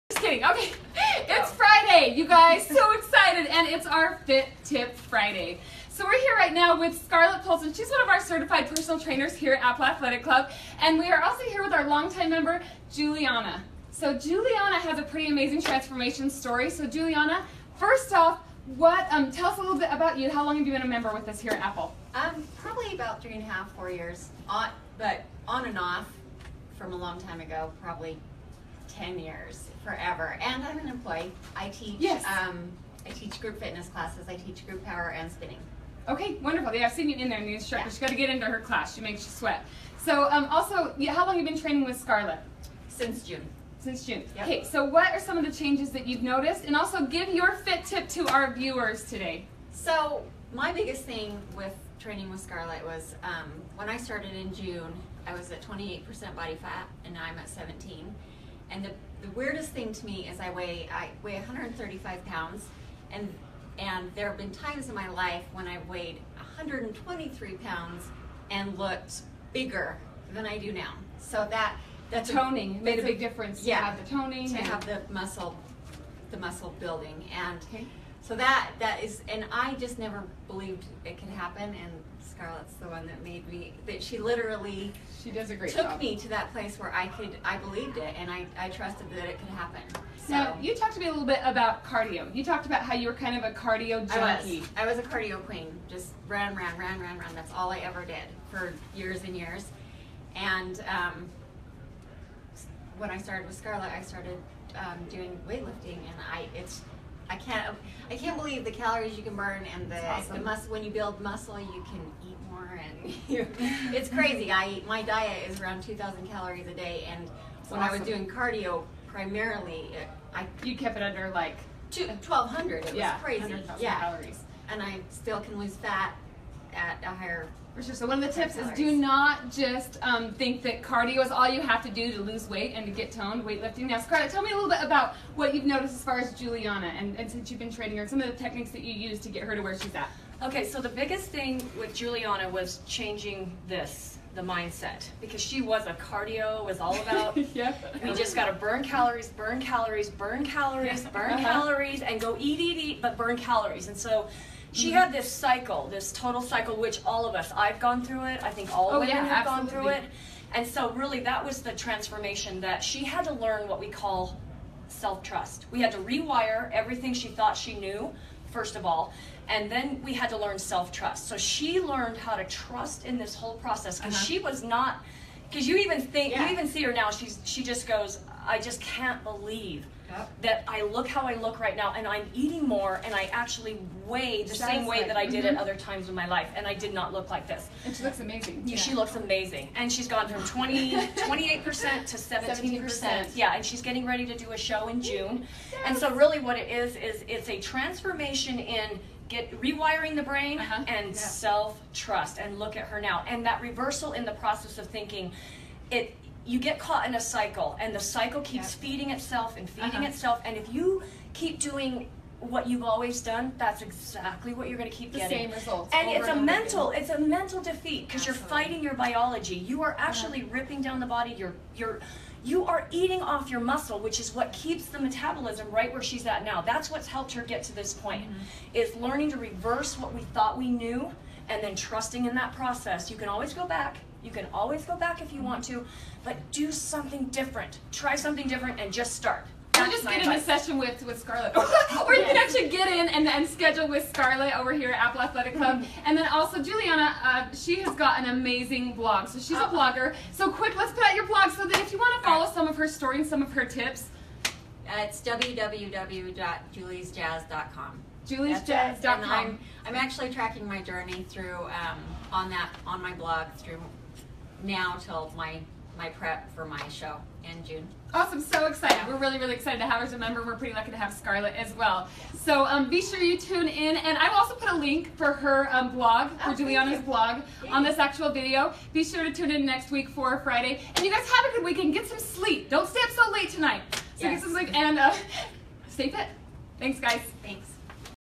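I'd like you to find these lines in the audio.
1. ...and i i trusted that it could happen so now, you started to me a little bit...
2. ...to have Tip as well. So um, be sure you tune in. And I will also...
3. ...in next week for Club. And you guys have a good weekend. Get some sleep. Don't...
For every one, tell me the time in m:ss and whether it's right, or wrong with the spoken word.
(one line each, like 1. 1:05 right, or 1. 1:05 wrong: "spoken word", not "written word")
1. 1:28 wrong: "talked", not "started"
2. 4:30 wrong: "Scarlett", not "Tip"
3. 4:39 wrong: "Friday", not "Club".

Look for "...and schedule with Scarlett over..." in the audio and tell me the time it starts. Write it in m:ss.
4:03.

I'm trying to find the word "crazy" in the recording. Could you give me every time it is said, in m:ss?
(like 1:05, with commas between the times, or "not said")
1:54, 2:03.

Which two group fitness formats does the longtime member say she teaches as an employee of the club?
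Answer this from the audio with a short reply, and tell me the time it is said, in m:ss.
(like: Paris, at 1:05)
group power and spinning, at 0:34.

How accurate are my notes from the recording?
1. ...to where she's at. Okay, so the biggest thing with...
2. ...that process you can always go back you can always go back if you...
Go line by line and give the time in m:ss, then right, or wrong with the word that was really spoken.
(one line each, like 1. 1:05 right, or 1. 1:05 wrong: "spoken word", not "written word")
1. 2:19 right
2. 3:52 right.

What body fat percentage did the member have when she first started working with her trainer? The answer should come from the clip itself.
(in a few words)
28%.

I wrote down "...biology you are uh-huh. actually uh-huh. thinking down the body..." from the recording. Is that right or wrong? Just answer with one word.
wrong.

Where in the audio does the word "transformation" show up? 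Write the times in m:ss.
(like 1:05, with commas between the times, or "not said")
0:15, 2:41, 3:17.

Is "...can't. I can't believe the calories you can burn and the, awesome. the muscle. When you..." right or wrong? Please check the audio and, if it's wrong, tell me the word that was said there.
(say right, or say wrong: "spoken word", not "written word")
right.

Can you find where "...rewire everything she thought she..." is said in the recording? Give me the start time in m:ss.
2:45.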